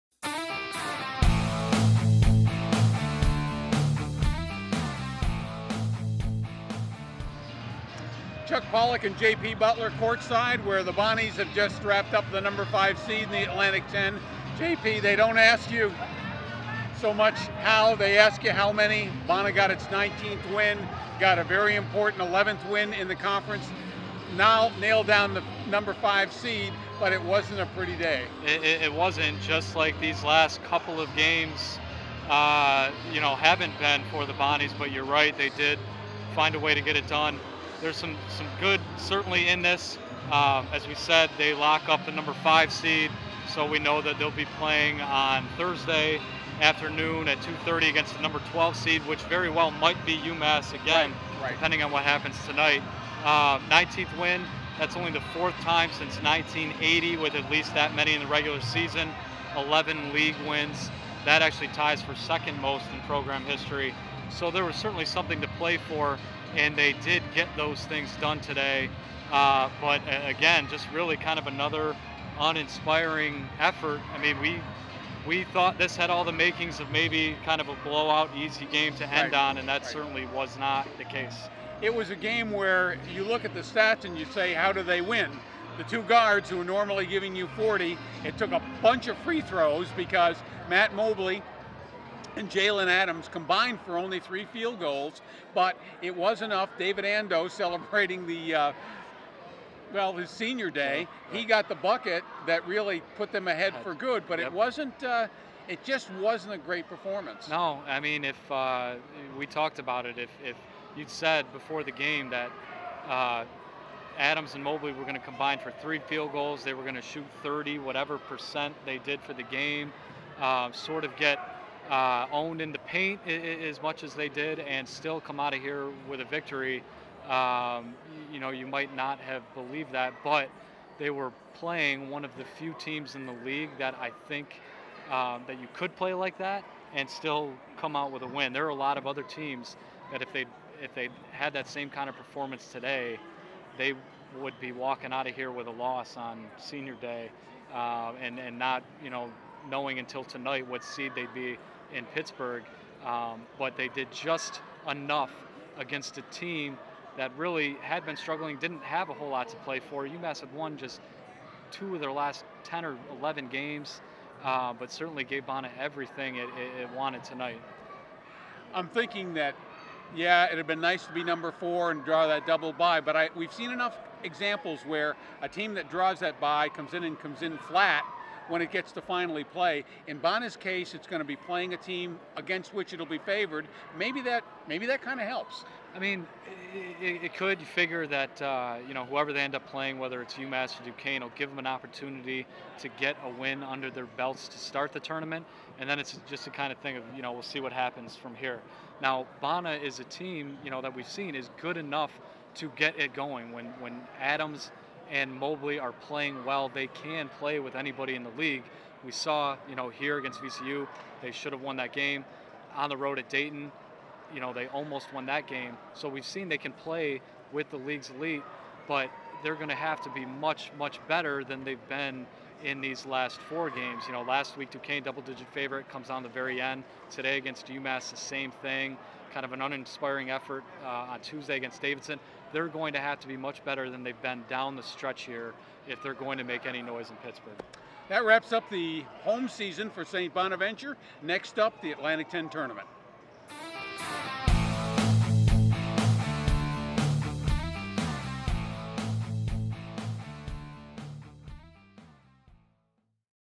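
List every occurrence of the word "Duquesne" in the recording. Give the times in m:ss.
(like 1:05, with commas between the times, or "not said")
3:10, 3:44.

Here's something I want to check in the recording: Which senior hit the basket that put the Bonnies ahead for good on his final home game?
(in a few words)
David Andoh.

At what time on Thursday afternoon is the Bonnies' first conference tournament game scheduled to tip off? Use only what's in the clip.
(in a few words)
2:30.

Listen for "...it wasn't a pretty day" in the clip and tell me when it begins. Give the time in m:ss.
0:27.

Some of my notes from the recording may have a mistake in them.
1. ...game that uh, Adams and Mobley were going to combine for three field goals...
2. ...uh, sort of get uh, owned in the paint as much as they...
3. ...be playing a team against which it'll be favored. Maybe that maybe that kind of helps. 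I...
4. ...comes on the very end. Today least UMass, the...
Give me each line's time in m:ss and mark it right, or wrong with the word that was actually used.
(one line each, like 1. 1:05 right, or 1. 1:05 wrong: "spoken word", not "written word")
1. 1:51 right
2. 2:00 right
3. 3:01 right
4. 3:45 wrong: "against", not "least".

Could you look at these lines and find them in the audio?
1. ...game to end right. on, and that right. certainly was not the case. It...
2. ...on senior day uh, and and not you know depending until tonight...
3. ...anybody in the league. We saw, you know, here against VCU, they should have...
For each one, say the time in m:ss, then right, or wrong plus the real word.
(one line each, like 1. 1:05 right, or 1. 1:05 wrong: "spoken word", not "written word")
1. 1:18 right
2. 2:26 wrong: "knowing", not "depending"
3. 3:27 right.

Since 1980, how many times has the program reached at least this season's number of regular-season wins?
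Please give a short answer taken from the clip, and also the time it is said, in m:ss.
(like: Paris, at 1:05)
4, at 0:55.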